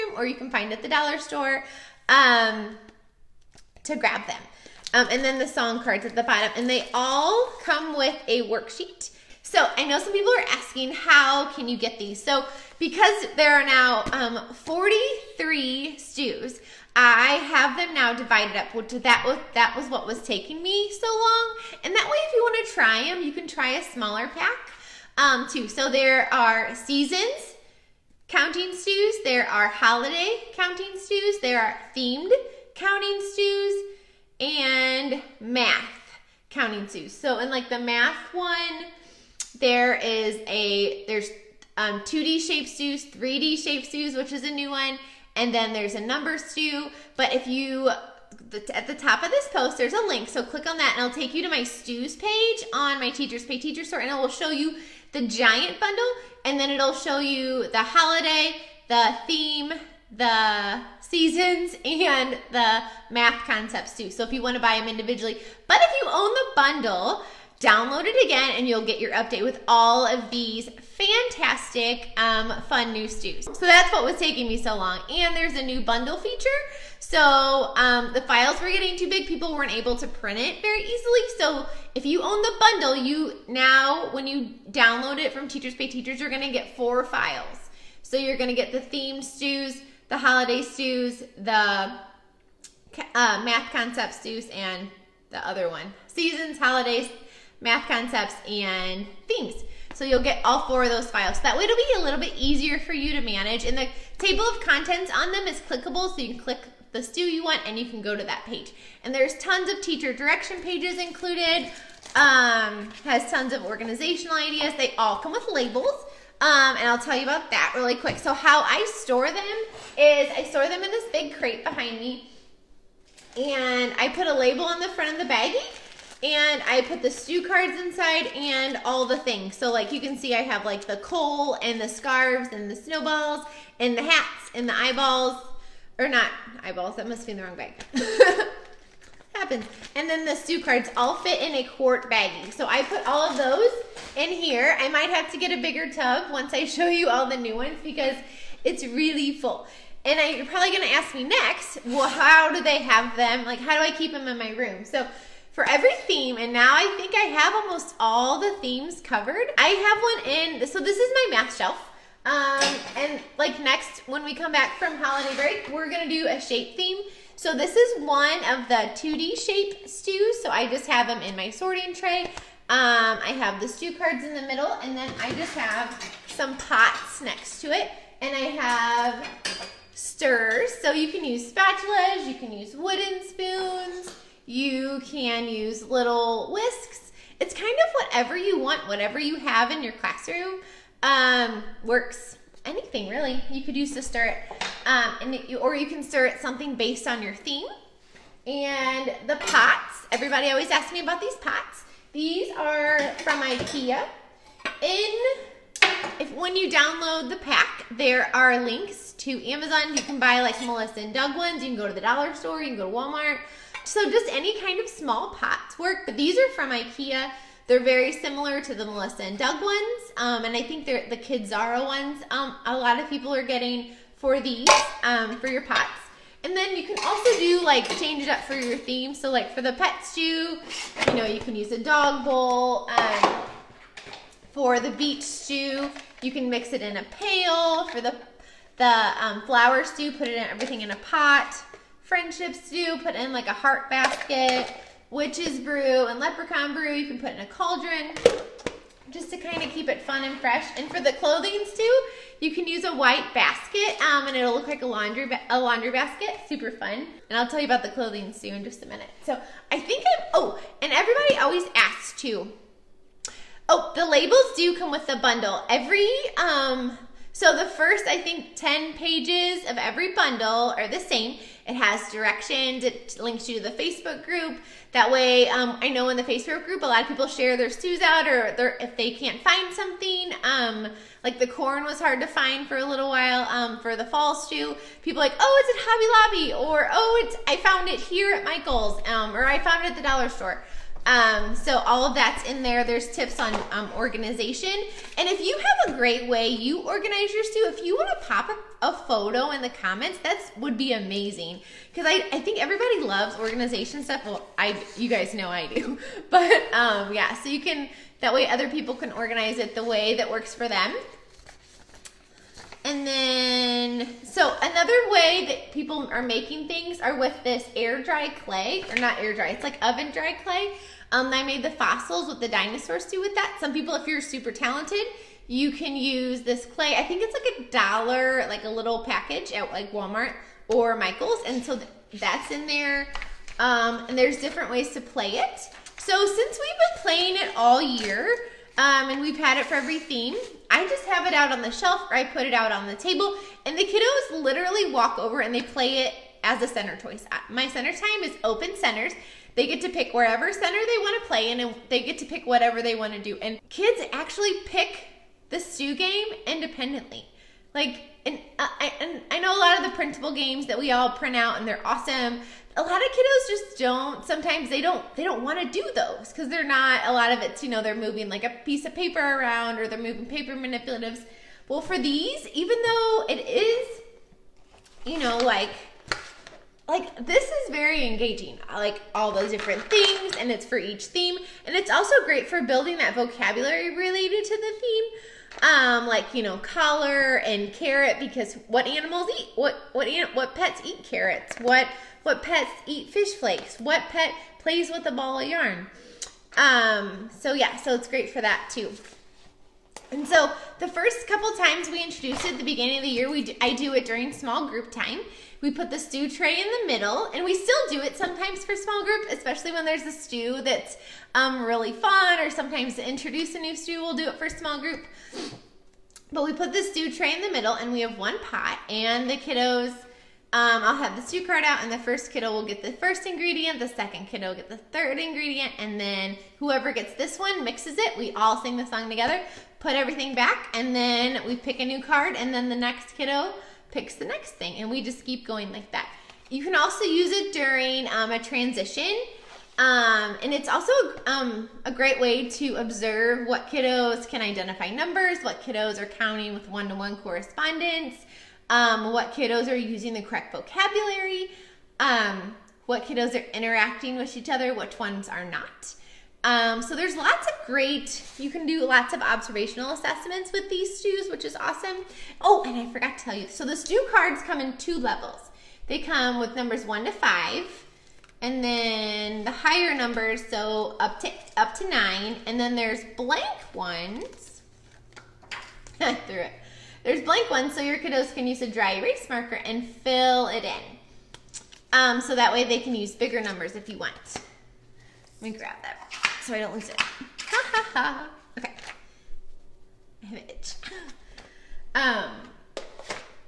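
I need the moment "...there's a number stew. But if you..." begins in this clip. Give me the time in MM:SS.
00:45.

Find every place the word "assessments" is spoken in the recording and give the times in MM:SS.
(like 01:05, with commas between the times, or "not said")
07:39.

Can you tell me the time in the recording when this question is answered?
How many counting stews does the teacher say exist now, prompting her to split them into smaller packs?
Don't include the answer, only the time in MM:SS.
00:14.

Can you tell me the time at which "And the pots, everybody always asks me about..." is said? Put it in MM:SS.
03:18.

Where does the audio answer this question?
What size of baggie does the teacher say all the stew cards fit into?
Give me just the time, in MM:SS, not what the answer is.
02:21.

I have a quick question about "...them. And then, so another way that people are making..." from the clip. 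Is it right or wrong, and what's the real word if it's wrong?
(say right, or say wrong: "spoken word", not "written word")
right.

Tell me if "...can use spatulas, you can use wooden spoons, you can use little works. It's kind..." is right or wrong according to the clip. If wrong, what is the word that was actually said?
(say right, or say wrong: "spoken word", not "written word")
wrong: "whisks", not "works".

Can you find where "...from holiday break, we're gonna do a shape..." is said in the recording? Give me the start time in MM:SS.
02:44.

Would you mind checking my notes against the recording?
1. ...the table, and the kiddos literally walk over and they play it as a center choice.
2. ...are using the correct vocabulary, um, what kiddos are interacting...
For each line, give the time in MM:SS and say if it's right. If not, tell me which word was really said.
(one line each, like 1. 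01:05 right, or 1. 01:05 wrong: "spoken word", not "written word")
1. 05:42 right
2. 07:29 right.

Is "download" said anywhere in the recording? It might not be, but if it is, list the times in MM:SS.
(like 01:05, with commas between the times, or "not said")
01:07, 01:24, 03:26.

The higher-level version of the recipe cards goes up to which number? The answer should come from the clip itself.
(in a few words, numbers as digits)
9.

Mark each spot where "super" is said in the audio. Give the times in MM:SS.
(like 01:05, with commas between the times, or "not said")
04:16, 05:24.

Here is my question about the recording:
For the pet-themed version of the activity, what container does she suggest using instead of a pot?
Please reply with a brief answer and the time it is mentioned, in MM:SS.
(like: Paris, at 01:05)
dog bowl, at 03:51.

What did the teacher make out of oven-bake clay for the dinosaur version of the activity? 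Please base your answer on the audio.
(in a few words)
fossils.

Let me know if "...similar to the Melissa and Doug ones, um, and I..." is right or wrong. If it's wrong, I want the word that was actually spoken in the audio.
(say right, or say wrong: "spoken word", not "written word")
right.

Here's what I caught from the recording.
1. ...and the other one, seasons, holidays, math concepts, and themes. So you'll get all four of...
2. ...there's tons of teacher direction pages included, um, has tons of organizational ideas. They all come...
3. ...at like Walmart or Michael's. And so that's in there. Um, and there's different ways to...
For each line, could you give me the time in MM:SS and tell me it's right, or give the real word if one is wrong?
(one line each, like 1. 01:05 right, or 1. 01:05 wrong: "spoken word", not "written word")
1. 01:34 right
2. 01:49 right
3. 05:29 right.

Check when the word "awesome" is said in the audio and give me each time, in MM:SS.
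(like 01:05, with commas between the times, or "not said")
06:01, 07:41.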